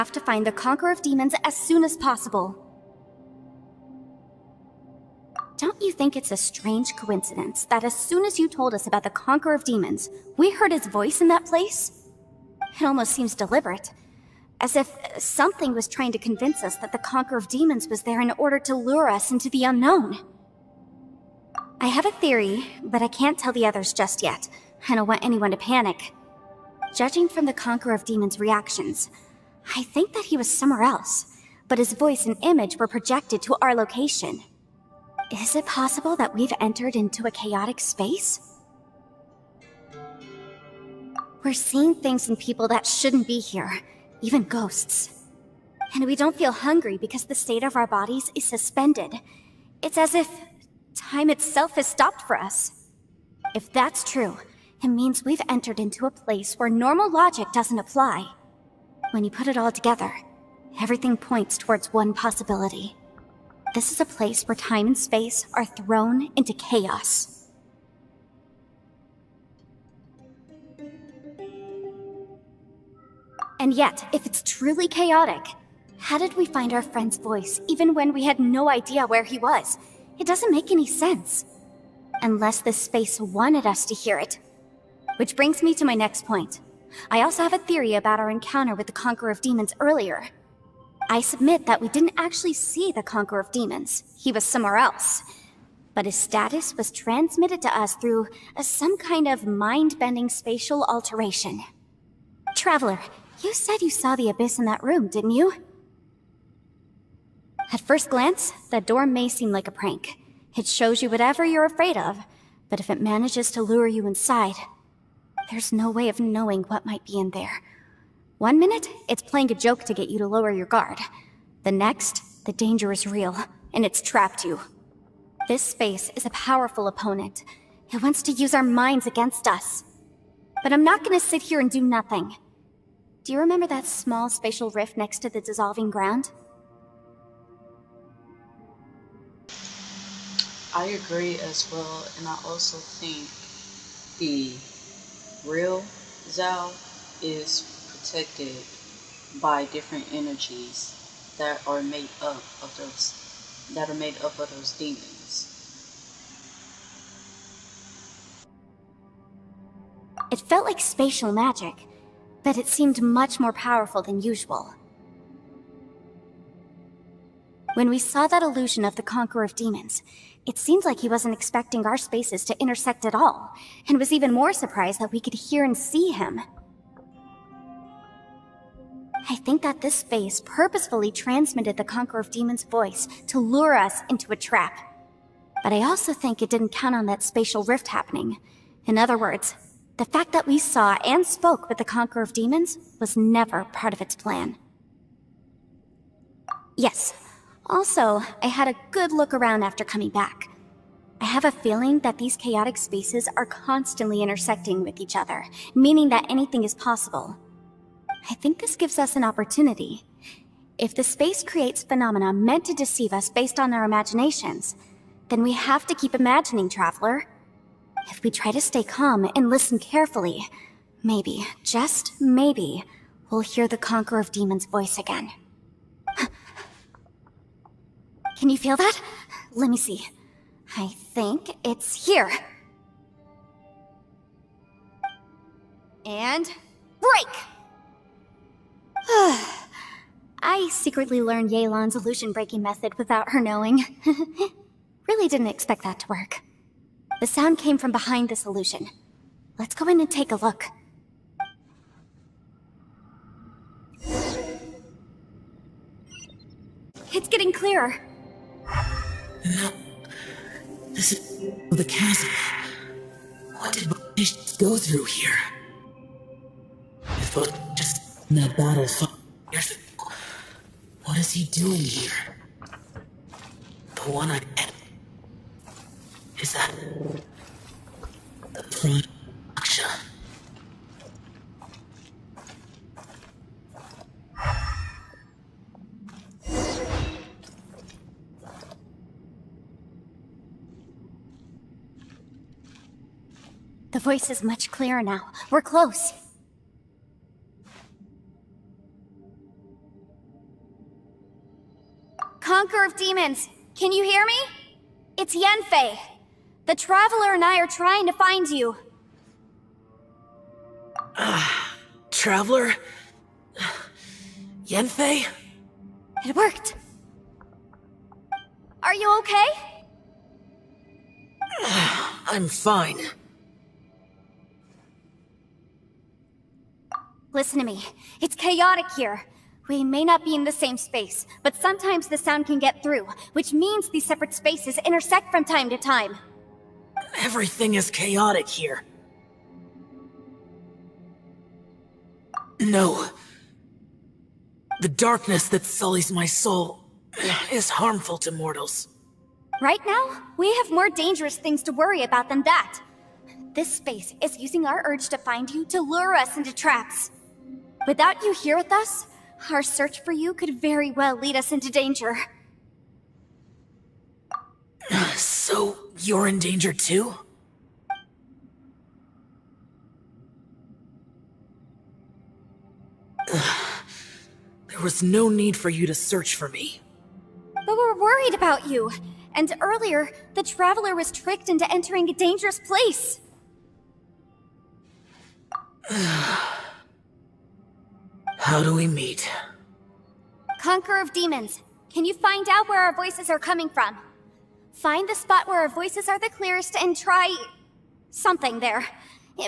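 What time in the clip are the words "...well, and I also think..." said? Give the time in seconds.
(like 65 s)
141 s.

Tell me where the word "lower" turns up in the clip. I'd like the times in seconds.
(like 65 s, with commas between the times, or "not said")
120 s.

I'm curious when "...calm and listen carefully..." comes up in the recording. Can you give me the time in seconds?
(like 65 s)
218 s.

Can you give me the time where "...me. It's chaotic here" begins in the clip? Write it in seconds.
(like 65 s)
327 s.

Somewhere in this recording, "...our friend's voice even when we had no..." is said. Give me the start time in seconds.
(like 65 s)
76 s.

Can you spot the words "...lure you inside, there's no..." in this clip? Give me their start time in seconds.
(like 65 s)
113 s.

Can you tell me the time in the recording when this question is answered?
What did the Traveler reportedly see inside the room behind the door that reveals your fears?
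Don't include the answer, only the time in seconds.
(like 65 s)
104 s.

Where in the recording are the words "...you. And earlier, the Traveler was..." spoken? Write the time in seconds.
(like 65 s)
378 s.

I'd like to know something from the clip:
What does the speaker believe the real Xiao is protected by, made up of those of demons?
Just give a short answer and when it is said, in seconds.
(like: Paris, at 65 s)
Different energies, at 149 s.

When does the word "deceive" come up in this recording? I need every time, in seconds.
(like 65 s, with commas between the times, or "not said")
212 s.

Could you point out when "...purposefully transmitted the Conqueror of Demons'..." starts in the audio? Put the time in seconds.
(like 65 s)
180 s.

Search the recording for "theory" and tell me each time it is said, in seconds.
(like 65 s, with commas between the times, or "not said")
22 s, 87 s.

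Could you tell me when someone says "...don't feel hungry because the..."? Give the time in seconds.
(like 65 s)
46 s.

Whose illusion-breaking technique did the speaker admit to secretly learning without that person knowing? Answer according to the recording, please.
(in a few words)
Yelan.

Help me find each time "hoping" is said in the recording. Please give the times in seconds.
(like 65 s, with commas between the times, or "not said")
not said.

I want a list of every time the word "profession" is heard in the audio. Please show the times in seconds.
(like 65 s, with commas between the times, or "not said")
not said.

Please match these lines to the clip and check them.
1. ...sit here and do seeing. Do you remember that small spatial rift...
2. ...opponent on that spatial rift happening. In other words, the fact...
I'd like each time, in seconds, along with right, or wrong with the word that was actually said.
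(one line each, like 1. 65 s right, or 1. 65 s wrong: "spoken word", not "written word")
1. 131 s wrong: "nothing", not "seeing"
2. 186 s wrong: "count", not "opponent".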